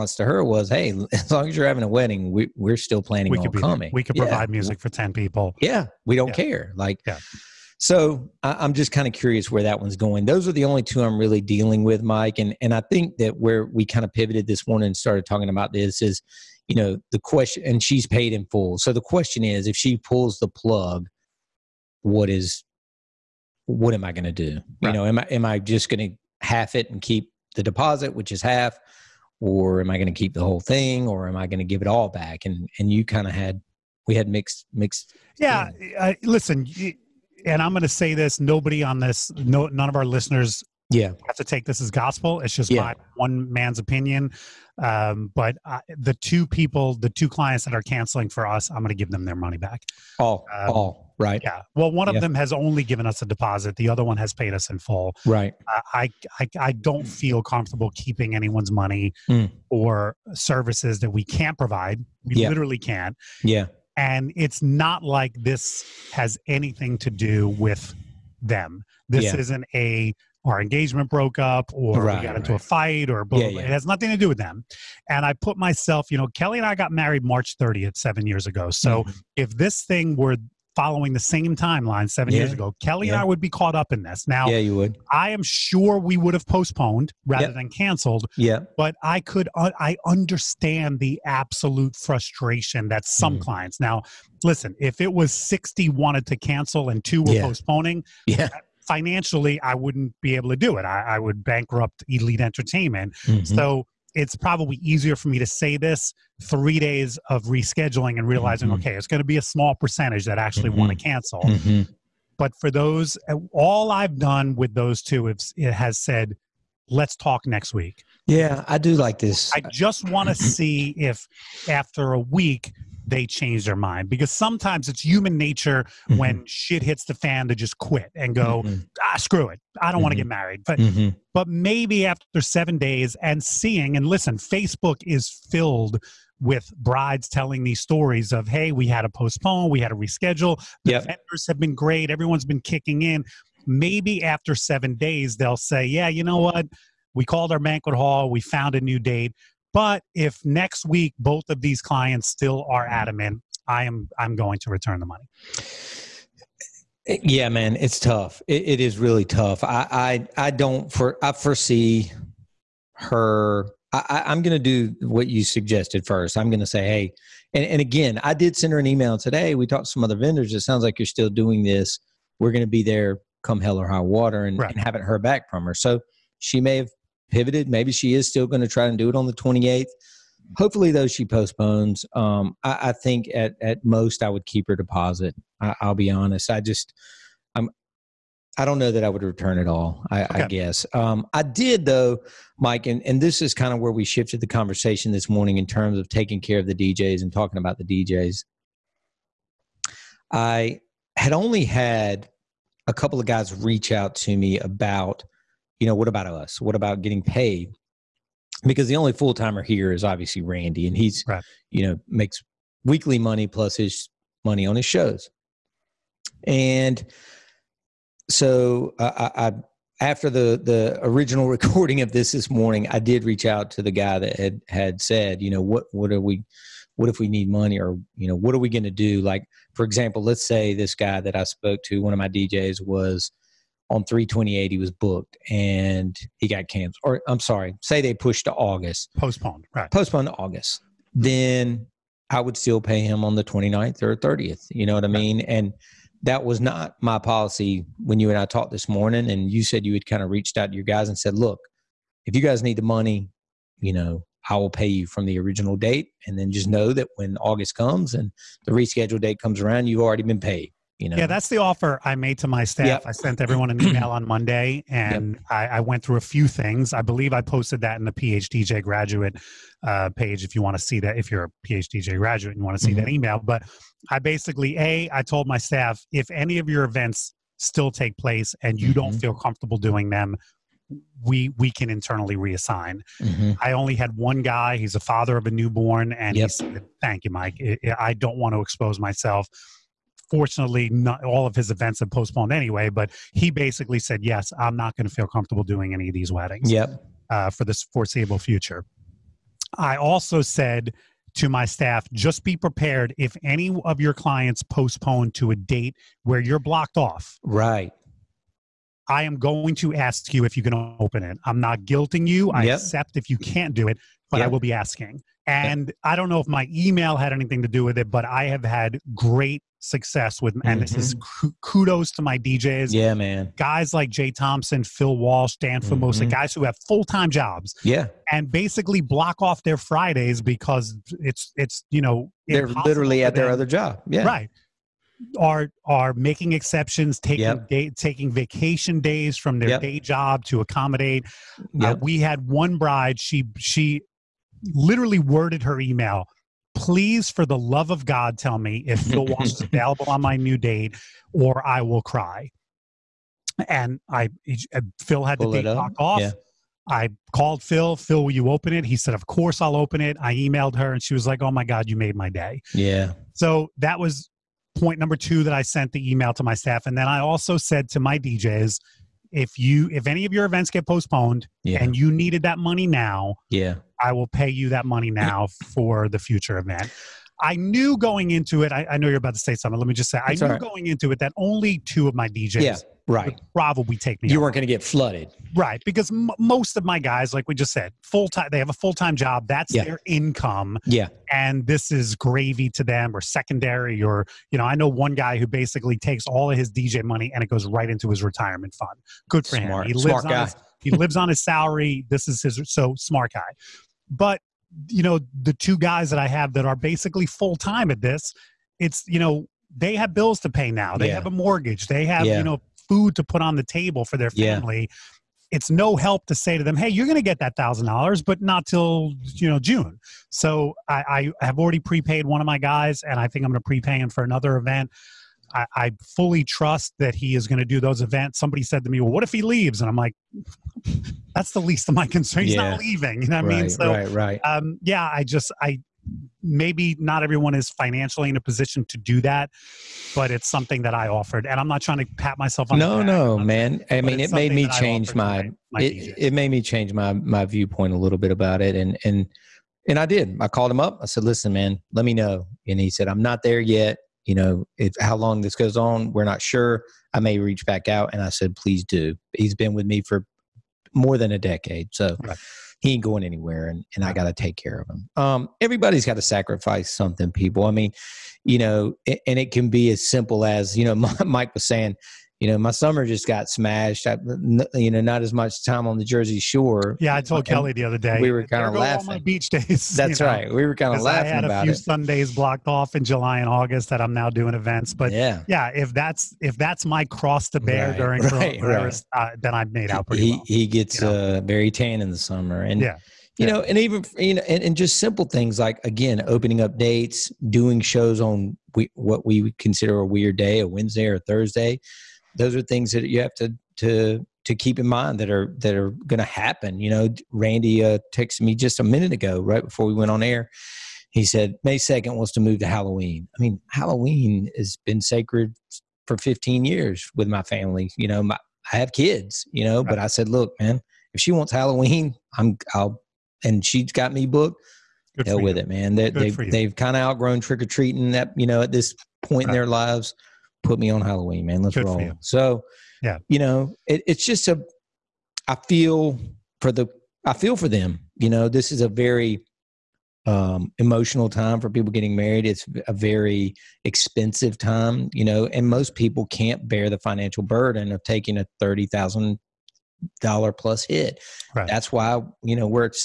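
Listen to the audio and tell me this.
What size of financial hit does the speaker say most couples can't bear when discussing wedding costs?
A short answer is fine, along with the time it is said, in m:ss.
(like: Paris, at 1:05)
$30,000, at 9:08.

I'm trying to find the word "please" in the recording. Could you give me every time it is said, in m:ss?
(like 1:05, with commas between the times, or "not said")
5:46, 7:38.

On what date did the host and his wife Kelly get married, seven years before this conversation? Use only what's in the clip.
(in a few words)
March 30th.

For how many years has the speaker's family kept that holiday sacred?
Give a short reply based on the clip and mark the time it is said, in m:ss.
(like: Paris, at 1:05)
15, at 8:36.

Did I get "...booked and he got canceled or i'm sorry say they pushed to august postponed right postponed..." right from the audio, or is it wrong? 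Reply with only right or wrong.
right.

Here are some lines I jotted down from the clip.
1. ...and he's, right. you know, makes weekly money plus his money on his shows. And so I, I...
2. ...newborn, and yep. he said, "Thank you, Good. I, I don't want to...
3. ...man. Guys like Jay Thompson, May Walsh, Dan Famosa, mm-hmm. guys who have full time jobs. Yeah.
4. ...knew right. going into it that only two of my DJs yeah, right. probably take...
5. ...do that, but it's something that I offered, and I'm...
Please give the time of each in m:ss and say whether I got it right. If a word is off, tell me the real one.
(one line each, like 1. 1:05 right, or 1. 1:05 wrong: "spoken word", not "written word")
1. 3:30 right
2. 4:45 wrong: "Mike", not "Good"
3. 5:23 wrong: "Phil", not "May"
4. 6:20 right
5. 7:18 right.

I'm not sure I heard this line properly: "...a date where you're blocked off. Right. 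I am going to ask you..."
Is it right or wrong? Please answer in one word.
right.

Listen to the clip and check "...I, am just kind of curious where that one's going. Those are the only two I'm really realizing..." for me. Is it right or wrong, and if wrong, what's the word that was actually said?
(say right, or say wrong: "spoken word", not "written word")
wrong: "dealing", not "realizing".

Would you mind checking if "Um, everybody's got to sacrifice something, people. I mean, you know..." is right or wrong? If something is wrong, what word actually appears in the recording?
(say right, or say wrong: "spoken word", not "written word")
right.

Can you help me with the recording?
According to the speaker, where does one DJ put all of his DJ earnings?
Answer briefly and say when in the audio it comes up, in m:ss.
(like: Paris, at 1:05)
Retirement fund, at 6:38.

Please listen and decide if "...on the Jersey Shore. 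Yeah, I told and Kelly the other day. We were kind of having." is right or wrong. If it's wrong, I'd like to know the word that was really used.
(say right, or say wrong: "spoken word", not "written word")
wrong: "laughing", not "having".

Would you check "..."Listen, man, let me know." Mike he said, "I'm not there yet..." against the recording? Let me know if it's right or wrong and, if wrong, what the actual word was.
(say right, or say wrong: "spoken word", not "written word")
wrong: "And", not "Mike".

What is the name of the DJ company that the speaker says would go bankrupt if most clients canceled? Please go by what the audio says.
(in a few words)
Elite Entertainment.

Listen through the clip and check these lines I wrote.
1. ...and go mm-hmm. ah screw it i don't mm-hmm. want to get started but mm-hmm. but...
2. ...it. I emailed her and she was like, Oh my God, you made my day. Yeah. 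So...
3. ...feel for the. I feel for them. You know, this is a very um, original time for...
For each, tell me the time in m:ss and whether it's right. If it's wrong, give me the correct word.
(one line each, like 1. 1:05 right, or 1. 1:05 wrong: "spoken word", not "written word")
1. 2:08 wrong: "married", not "started"
2. 6:00 right
3. 8:55 wrong: "emotional", not "original".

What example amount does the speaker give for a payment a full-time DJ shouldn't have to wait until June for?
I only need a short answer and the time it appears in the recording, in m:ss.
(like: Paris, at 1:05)
$1,000, at 6:57.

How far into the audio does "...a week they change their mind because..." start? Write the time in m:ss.
2:02.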